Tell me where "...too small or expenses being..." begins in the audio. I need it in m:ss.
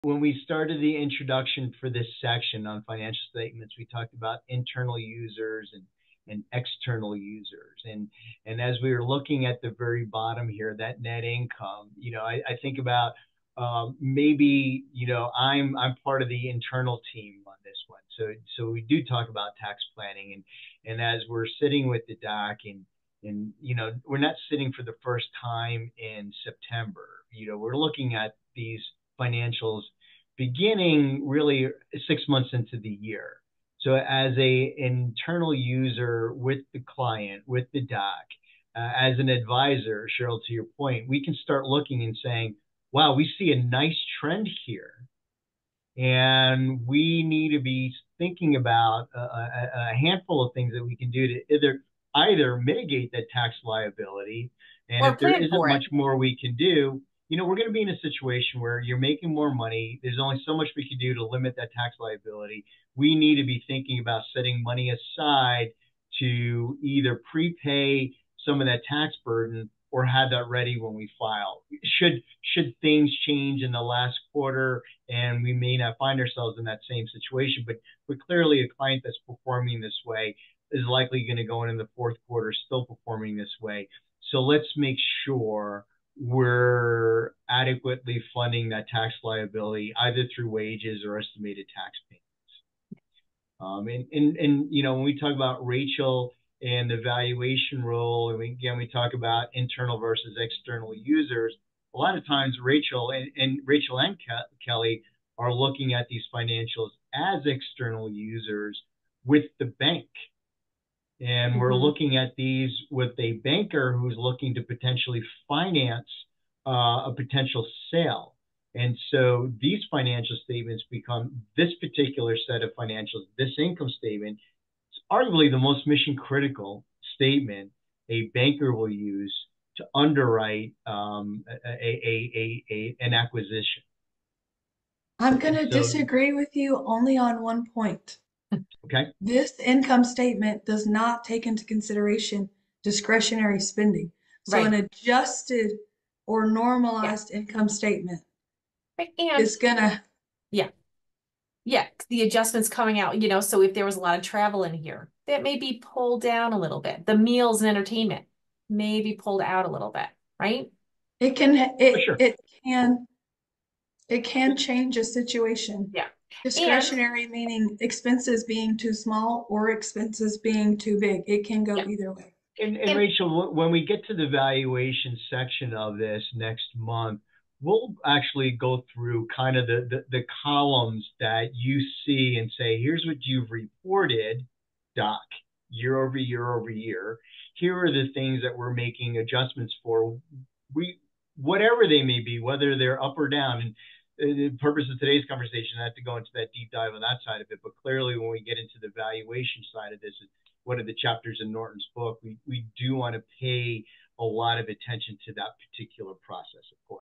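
2:48.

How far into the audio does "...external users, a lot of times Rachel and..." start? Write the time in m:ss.
1:40.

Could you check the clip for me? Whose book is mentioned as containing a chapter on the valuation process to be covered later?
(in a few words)
Norton.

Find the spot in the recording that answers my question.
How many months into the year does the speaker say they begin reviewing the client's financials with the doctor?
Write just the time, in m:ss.
0:32.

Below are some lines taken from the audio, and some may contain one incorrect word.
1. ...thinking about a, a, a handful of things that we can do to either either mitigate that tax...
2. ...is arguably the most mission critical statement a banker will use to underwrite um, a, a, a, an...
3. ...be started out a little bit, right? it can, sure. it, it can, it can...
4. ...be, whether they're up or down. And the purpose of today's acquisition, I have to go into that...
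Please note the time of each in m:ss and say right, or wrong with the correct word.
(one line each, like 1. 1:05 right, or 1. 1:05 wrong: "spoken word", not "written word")
1. 0:48 right
2. 2:04 right
3. 2:39 wrong: "pulled", not "started"
4. 3:12 wrong: "conversation", not "acquisition".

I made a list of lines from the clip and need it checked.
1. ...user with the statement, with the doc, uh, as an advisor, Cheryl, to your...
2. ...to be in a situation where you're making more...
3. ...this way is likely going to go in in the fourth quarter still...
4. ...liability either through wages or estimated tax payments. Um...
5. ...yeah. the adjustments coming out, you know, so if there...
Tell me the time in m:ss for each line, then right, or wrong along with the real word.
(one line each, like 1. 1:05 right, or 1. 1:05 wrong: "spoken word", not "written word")
1. 0:35 wrong: "client", not "statement"
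2. 0:57 right
3. 1:19 right
4. 1:29 right
5. 2:31 right.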